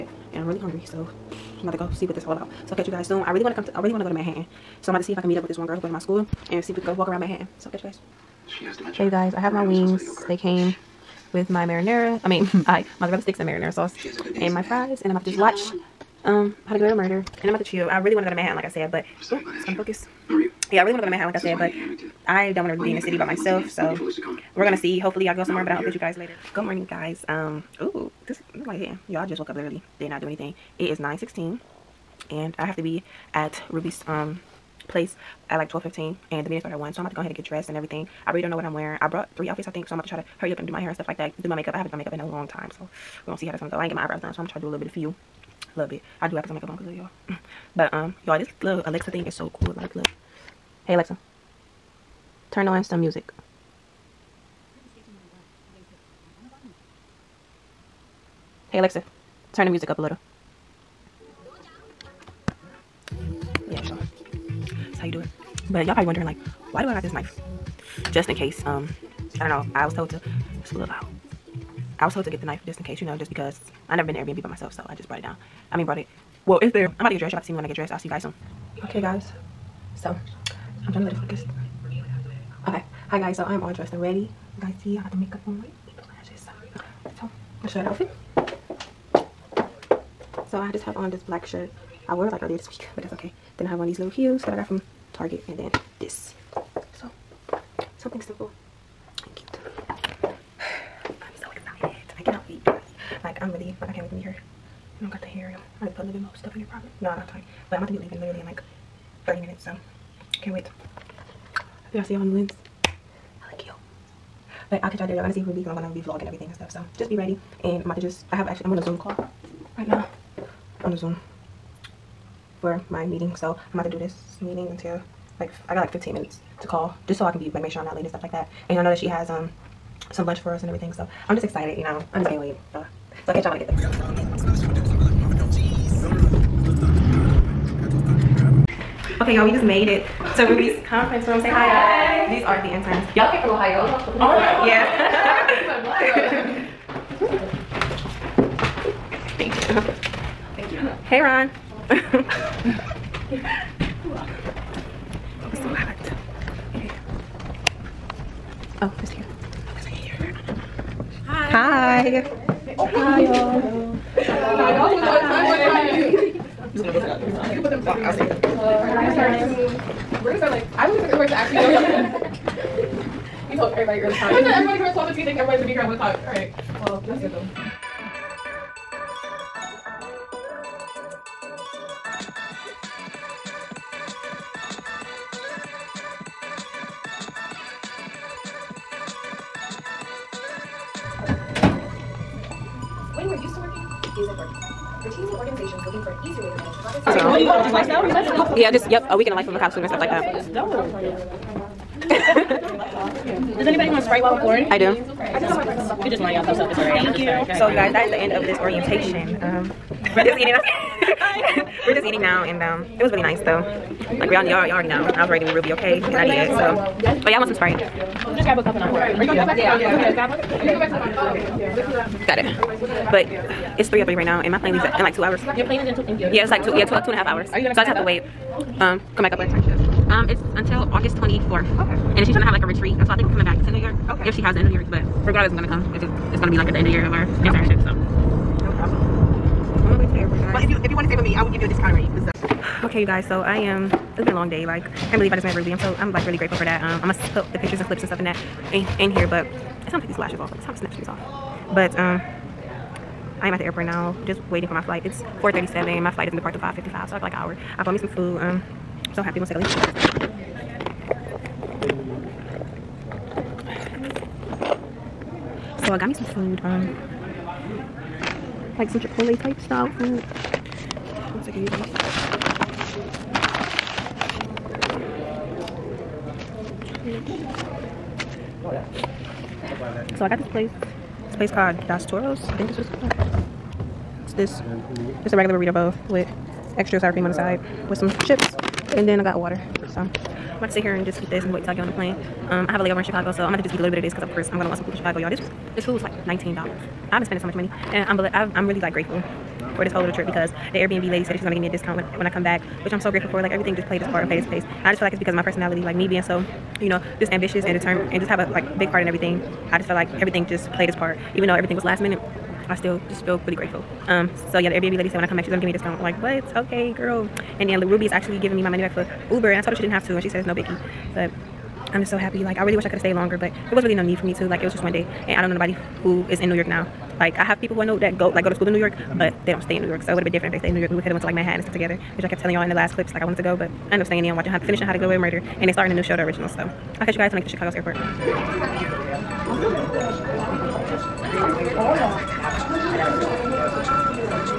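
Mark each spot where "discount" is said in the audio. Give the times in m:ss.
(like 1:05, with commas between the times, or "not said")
4:01, 5:01, 5:15.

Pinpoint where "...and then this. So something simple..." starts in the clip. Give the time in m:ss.
1:35.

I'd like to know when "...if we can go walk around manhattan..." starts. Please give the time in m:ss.
0:06.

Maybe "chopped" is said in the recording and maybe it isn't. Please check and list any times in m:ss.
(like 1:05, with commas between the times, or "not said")
not said.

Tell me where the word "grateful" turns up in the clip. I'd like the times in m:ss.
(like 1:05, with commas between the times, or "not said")
4:06, 4:58, 5:03, 5:13.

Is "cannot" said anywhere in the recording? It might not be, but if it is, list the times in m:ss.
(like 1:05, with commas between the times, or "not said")
1:42.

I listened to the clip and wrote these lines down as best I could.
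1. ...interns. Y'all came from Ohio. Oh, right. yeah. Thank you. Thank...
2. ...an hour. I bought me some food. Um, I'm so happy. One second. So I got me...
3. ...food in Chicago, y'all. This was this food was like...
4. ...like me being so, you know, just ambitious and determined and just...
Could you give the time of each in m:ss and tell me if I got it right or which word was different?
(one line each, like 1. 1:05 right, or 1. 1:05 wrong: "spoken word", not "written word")
1. 2:22 right
2. 4:17 right
3. 4:54 right
4. 5:05 right.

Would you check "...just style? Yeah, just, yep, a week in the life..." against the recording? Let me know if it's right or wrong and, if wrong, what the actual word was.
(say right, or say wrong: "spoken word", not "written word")
wrong: "lifestyle", not "style".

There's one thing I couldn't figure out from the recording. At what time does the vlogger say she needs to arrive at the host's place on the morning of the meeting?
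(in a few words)
12:15.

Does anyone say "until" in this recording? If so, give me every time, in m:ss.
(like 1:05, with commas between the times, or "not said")
2:04, 3:50.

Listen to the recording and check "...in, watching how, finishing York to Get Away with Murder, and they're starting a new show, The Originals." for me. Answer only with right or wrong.
wrong.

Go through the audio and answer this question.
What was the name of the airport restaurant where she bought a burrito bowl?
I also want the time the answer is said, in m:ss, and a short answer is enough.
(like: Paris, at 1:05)
Dos Toros, at 4:41.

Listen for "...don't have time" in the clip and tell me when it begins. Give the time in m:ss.
1:47.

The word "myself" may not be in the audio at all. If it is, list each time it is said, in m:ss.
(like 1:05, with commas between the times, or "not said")
0:23, 1:14.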